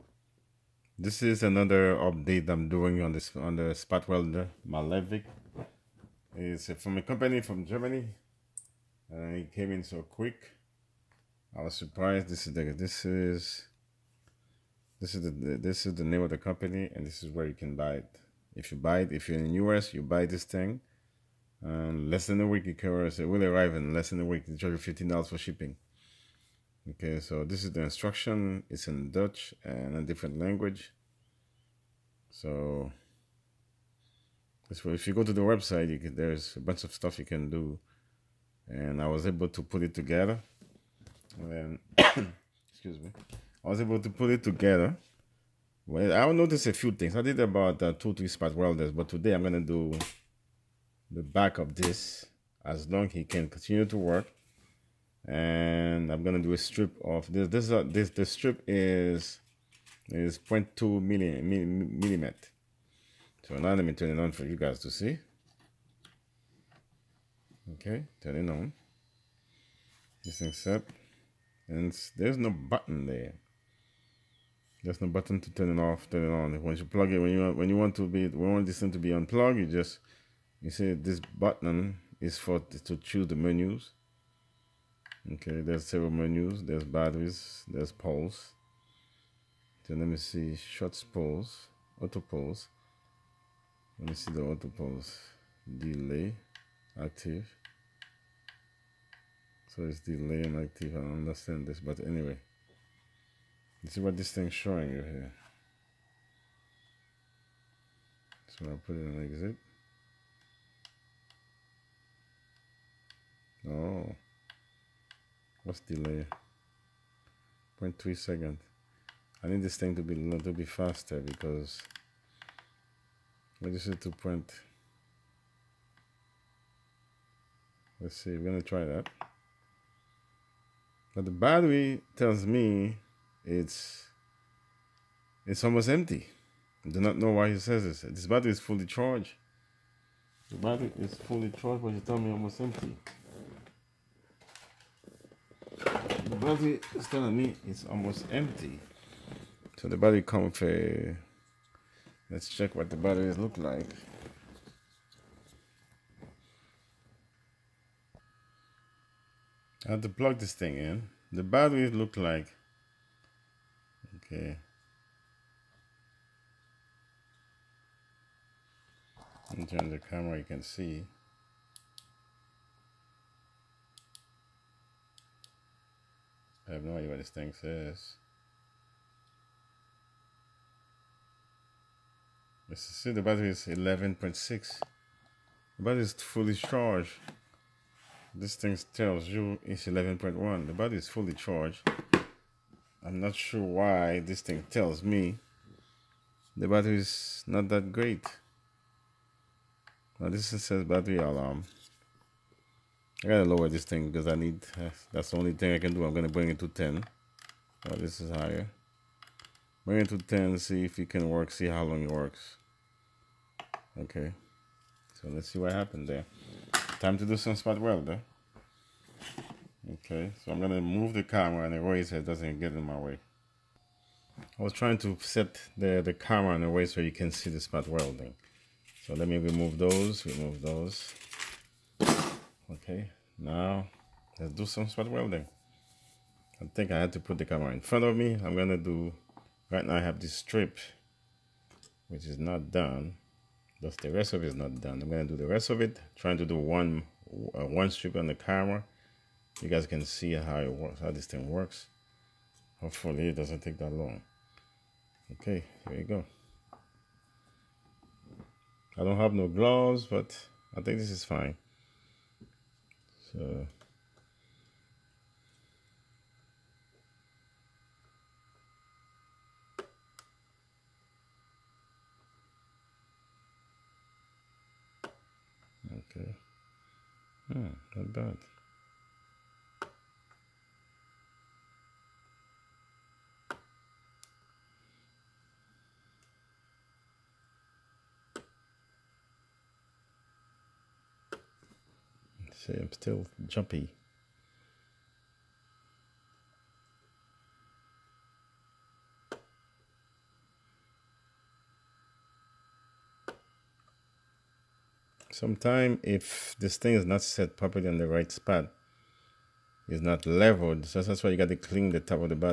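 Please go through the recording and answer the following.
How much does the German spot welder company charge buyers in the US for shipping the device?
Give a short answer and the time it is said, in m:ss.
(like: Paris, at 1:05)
$15, at 0:24.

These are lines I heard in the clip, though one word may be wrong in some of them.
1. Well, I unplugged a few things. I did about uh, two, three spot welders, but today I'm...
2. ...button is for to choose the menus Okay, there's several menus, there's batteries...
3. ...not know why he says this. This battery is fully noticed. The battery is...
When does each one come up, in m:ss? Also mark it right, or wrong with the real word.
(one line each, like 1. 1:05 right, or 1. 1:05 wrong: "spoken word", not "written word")
1. 0:45 wrong: "noticed", not "unplugged"
2. 1:21 right
3. 2:17 wrong: "charged", not "noticed".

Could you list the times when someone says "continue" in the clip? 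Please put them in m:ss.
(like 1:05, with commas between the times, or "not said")
0:53.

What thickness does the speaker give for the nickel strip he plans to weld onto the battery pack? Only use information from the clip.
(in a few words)
0.2 millimeter.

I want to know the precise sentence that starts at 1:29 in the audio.
Then let me see shots pulse, auto pulse.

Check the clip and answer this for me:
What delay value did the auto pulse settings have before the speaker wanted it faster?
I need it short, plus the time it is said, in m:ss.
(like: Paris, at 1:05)
0.3 second, at 1:57.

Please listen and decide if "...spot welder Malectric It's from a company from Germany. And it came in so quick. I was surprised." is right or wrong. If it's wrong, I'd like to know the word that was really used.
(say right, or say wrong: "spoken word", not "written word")
right.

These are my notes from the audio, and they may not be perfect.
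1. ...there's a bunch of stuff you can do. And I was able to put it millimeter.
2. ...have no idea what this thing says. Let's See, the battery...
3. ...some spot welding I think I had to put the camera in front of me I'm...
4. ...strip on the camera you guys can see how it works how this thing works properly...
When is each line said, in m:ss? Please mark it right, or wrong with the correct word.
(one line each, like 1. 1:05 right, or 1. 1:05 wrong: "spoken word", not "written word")
1. 0:36 wrong: "together", not "millimeter"
2. 2:56 right
3. 3:54 right
4. 4:07 wrong: "hopefully", not "properly".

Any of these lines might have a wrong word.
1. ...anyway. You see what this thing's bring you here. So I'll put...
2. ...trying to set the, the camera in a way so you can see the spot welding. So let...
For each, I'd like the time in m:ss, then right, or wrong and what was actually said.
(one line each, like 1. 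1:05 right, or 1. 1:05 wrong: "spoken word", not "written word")
1. 1:42 wrong: "showing", not "bring"
2. 3:44 right.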